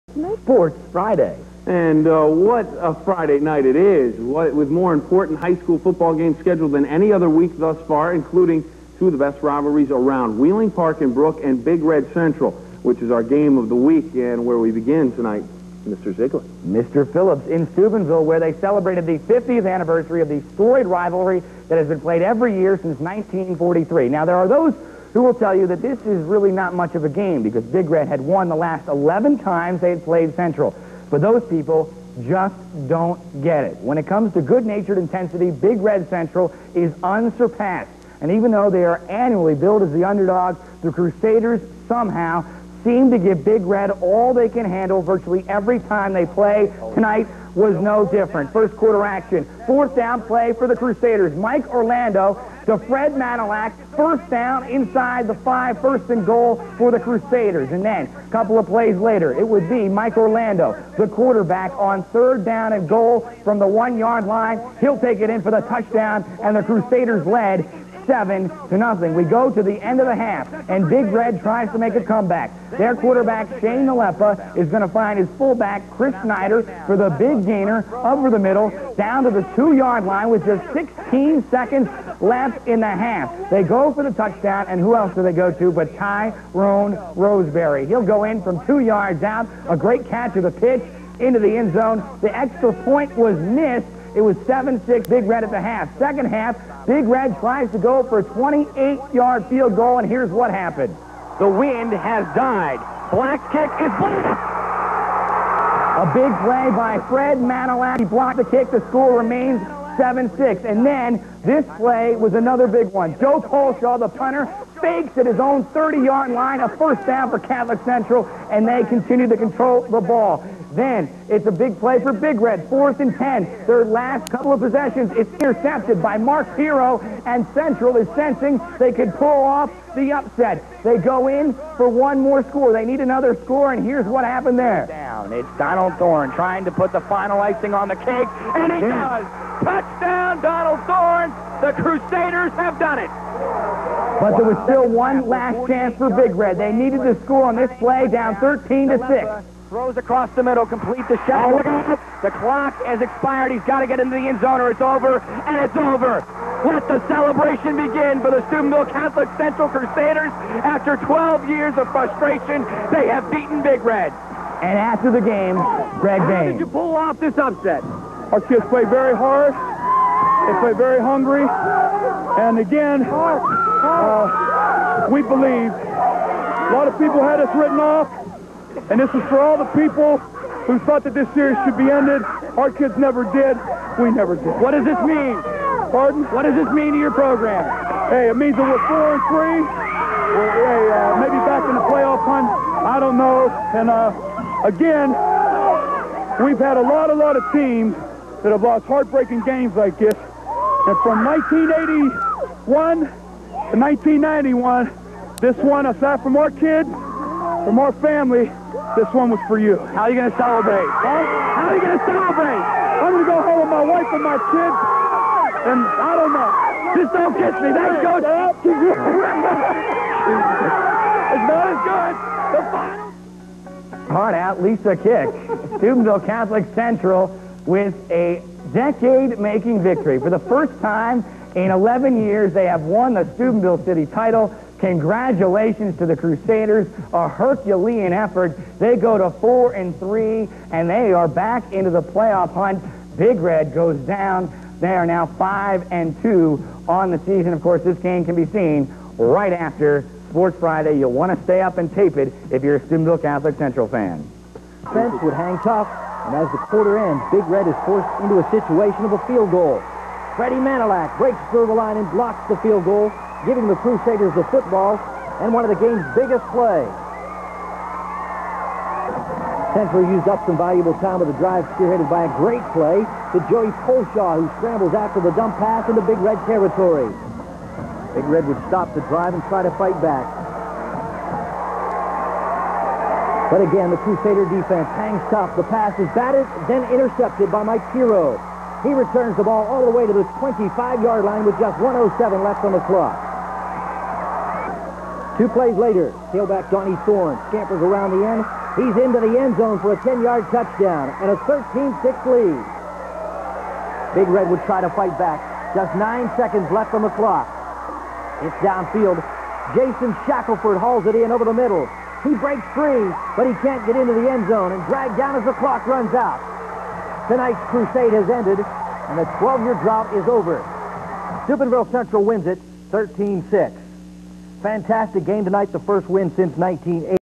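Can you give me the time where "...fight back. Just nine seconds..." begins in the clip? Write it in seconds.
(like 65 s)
304 s.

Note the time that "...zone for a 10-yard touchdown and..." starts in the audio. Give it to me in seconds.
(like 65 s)
299 s.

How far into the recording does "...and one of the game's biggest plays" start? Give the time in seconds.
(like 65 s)
265 s.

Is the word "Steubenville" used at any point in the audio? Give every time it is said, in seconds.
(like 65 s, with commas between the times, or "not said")
17 s, 158 s, 225 s, 233 s, 252 s, 321 s.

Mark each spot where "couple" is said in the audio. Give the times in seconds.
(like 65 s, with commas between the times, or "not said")
58 s, 124 s.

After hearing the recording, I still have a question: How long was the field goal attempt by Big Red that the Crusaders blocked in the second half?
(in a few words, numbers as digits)
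28 yards.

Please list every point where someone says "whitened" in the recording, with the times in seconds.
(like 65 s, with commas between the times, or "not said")
not said.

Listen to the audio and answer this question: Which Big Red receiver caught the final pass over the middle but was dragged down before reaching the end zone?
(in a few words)
Jason Shackelford.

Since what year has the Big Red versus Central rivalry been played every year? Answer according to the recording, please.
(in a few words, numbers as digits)
1943.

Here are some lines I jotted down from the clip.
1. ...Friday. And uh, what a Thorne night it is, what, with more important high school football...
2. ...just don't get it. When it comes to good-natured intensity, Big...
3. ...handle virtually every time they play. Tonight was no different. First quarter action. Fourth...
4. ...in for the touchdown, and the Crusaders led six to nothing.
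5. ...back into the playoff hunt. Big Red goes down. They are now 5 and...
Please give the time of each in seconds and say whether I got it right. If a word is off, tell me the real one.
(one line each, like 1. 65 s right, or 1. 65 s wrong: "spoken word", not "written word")
1. 0 s wrong: "Friday", not "Thorne"
2. 32 s right
3. 44 s right
4. 65 s wrong: "seven", not "six"
5. 241 s right.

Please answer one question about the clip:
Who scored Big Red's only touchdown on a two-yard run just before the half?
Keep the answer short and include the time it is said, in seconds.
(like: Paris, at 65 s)
Tyrone Roseberry, at 85 s.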